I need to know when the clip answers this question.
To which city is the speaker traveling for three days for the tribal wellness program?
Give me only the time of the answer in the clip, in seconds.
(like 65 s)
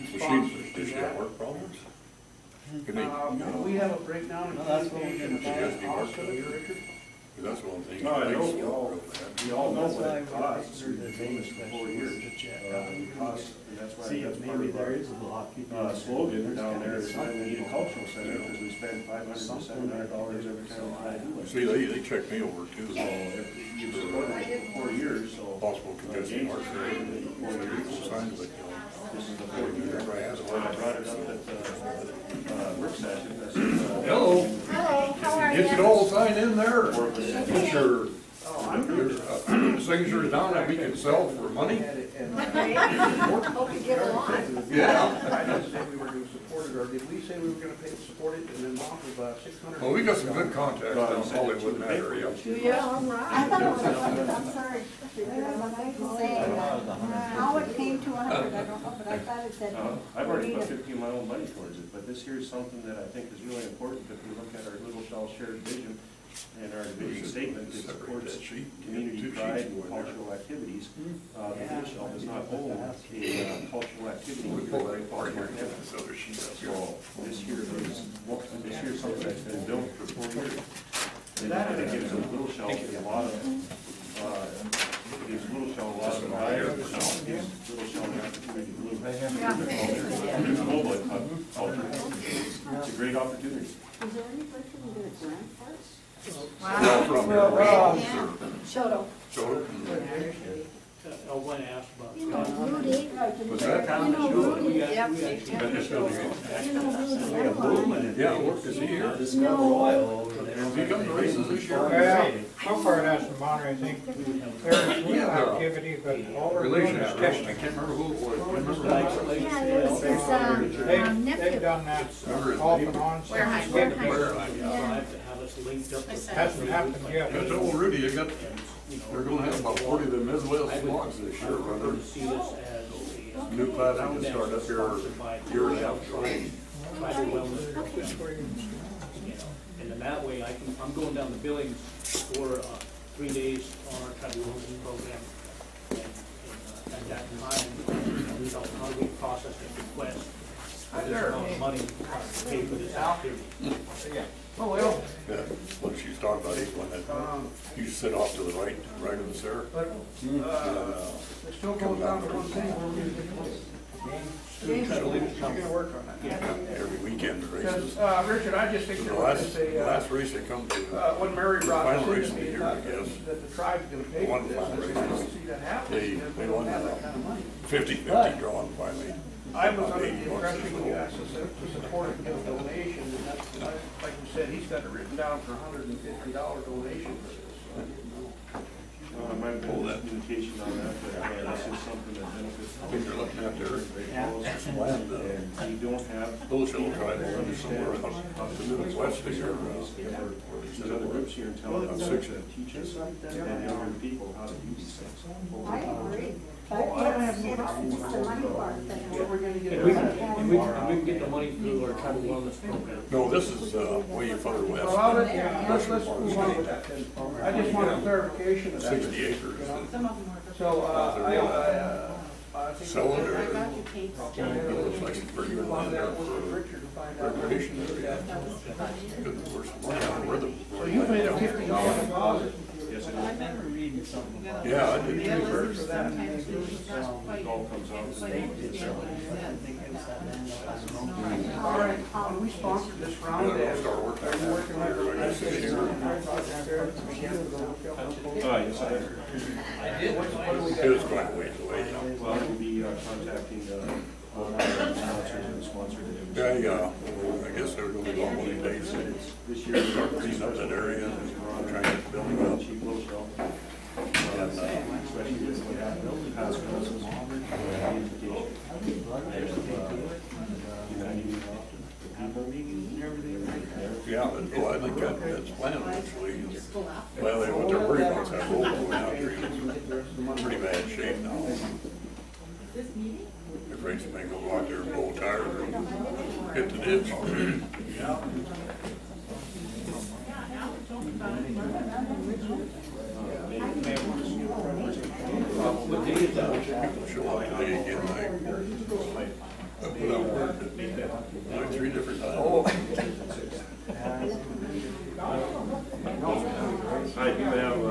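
141 s.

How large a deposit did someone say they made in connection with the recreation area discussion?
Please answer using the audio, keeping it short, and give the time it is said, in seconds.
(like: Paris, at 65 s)
$50, at 231 s.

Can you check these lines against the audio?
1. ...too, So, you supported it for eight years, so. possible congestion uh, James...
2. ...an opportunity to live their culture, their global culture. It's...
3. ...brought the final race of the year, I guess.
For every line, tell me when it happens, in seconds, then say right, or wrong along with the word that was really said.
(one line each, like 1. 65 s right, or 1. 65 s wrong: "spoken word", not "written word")
1. 22 s wrong: "four", not "eight"
2. 88 s right
3. 171 s right.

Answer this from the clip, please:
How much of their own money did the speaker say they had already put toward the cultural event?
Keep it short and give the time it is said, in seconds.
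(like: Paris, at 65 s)
15, at 60 s.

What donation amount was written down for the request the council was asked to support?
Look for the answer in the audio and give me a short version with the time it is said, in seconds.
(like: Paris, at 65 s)
$150, at 185 s.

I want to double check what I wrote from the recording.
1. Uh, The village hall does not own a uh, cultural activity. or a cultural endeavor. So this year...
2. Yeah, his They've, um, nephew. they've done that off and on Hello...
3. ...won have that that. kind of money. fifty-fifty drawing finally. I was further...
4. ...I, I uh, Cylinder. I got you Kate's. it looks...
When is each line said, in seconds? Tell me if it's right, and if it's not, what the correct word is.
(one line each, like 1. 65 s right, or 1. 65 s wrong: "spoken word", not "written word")
1. 71 s right
2. 119 s wrong: "Where", not "Hello"
3. 176 s wrong: "under", not "further"
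4. 221 s right.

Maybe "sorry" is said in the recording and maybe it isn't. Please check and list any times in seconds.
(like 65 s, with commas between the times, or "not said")
54 s.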